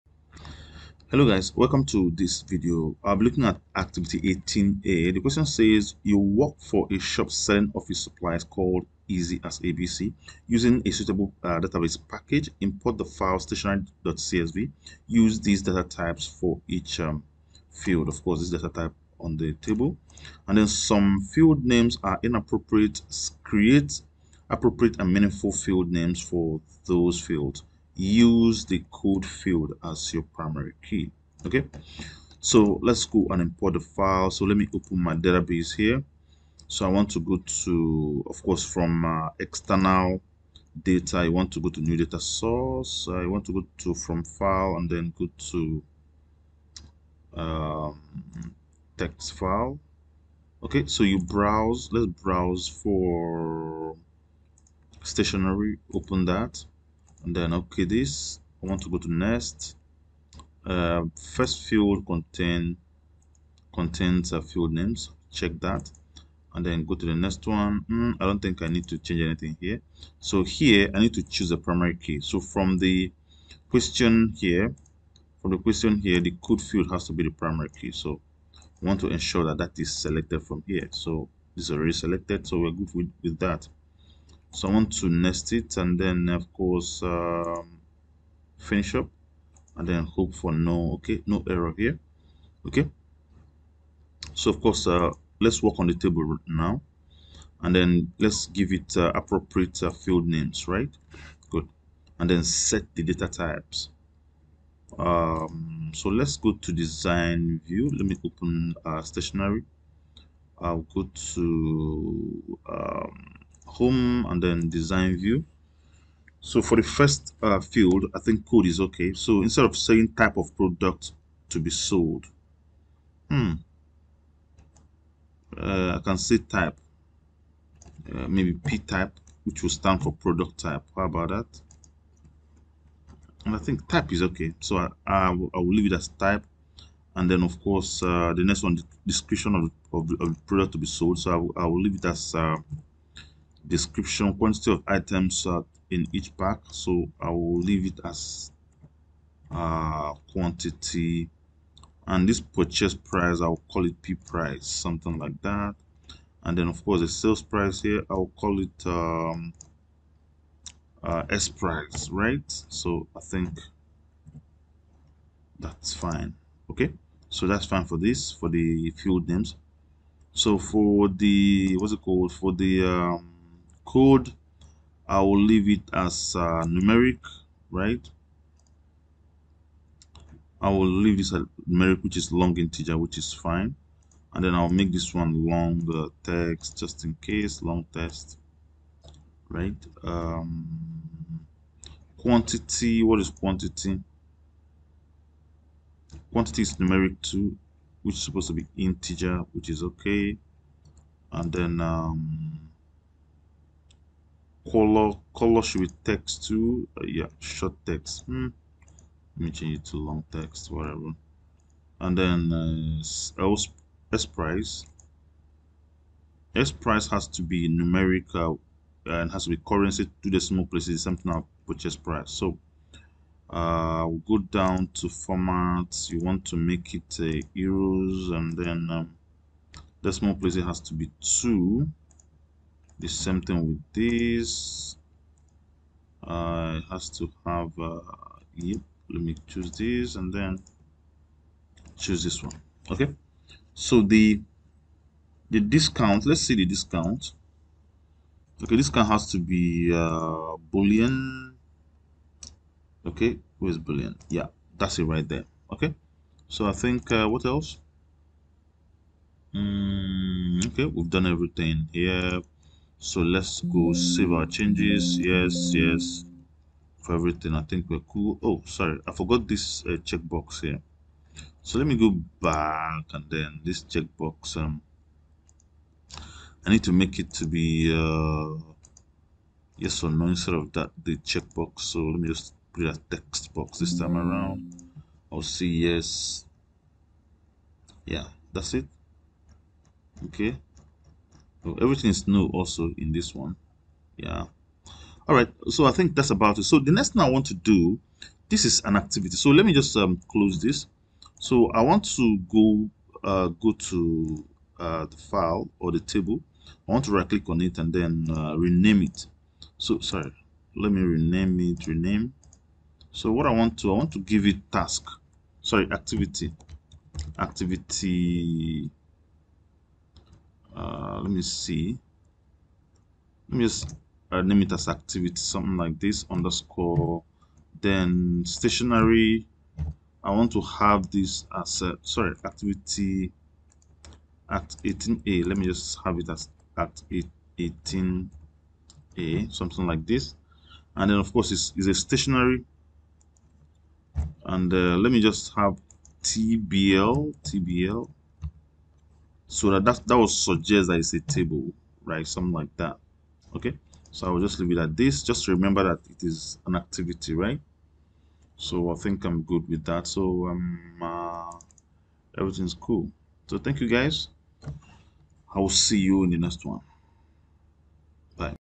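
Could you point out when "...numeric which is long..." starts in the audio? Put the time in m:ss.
3:01.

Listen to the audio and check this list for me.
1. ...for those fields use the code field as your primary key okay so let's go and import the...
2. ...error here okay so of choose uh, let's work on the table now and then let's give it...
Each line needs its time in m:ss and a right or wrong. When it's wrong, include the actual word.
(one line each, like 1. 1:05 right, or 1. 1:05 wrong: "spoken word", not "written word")
1. 0:26 right
2. 1:31 wrong: "course", not "choose".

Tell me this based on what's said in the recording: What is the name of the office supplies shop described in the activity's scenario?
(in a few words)
Easy as ABC.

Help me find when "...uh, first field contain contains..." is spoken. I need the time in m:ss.
1:00.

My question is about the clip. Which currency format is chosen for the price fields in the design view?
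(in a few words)
Euros.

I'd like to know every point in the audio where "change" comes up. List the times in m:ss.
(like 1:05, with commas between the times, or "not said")
1:08, 3:29, 4:24.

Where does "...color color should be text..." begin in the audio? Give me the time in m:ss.
3:24.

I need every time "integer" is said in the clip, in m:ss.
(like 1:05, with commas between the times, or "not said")
3:02, 3:18.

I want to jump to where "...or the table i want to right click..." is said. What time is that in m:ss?
5:05.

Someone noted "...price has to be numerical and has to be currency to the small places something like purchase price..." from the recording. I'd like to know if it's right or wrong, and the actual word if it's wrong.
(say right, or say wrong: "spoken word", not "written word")
right.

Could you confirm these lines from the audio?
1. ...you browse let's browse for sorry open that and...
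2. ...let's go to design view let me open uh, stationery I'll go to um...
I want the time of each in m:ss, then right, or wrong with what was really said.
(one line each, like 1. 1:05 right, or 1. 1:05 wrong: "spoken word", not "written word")
1. 0:51 wrong: "stationery", not "sorry"
2. 1:46 right.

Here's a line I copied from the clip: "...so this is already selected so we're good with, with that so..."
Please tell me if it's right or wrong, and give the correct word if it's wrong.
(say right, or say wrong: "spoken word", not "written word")
right.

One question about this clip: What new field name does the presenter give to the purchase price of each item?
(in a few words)
P price.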